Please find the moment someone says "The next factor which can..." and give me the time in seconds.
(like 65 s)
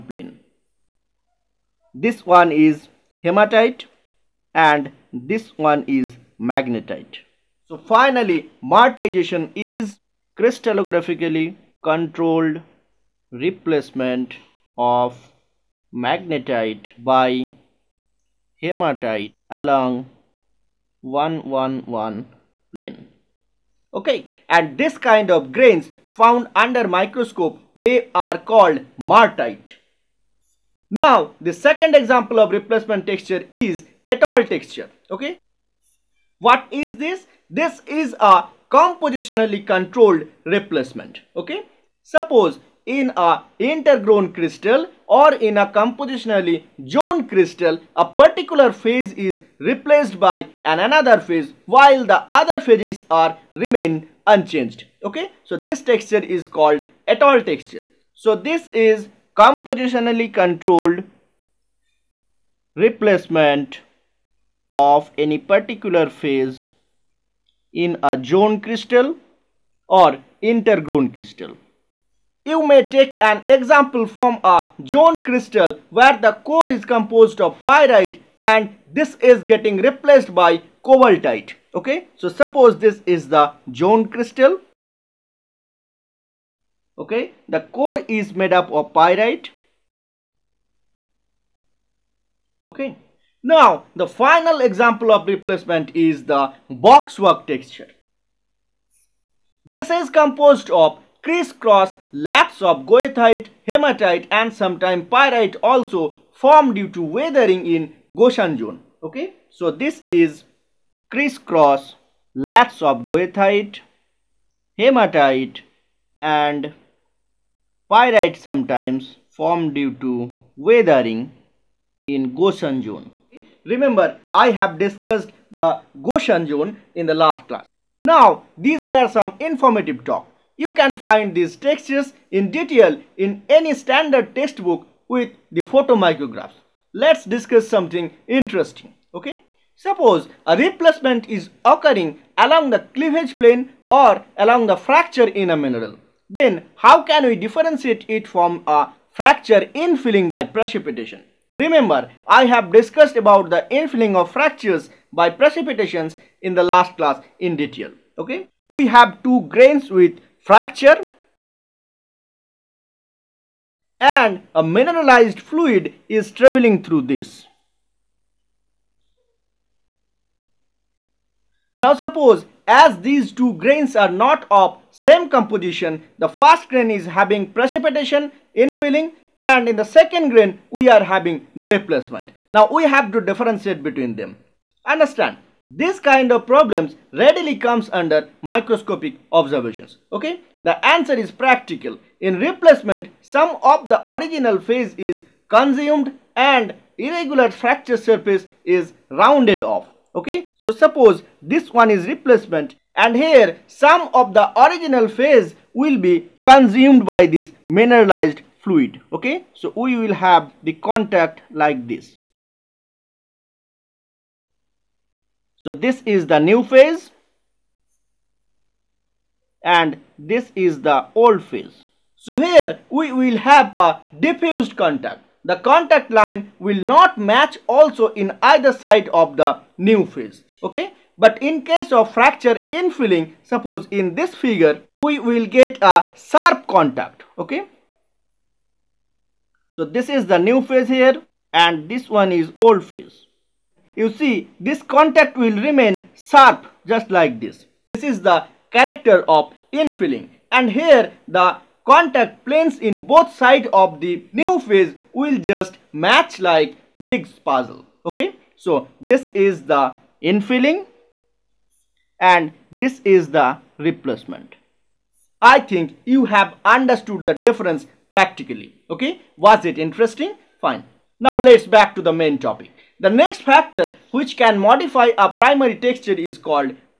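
272 s.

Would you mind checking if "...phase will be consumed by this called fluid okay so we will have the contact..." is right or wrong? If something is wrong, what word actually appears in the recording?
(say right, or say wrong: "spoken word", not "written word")
wrong: "mineralized", not "called".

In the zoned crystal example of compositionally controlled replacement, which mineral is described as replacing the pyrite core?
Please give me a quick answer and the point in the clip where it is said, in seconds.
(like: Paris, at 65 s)
Cobaltite, at 80 s.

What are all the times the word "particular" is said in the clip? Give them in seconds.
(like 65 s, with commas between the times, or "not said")
48 s, 65 s.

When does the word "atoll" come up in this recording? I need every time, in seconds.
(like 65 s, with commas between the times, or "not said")
34 s, 57 s.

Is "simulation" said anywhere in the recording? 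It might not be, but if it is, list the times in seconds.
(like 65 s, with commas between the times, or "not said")
not said.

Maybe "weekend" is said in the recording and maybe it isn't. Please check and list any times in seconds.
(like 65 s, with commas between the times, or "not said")
not said.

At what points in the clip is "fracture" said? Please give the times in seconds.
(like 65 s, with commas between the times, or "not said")
144 s, 149 s, 154 s, 160 s, 197 s, 232 s.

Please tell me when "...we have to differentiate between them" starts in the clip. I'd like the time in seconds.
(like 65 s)
182 s.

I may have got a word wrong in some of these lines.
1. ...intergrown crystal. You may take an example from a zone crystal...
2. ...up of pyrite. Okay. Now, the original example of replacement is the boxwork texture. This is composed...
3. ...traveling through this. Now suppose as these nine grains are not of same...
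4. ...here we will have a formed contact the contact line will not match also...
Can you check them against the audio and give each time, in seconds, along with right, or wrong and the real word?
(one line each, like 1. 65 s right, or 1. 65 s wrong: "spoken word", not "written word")
1. 70 s right
2. 88 s wrong: "final", not "original"
3. 166 s wrong: "two", not "nine"
4. 222 s wrong: "diffused", not "formed".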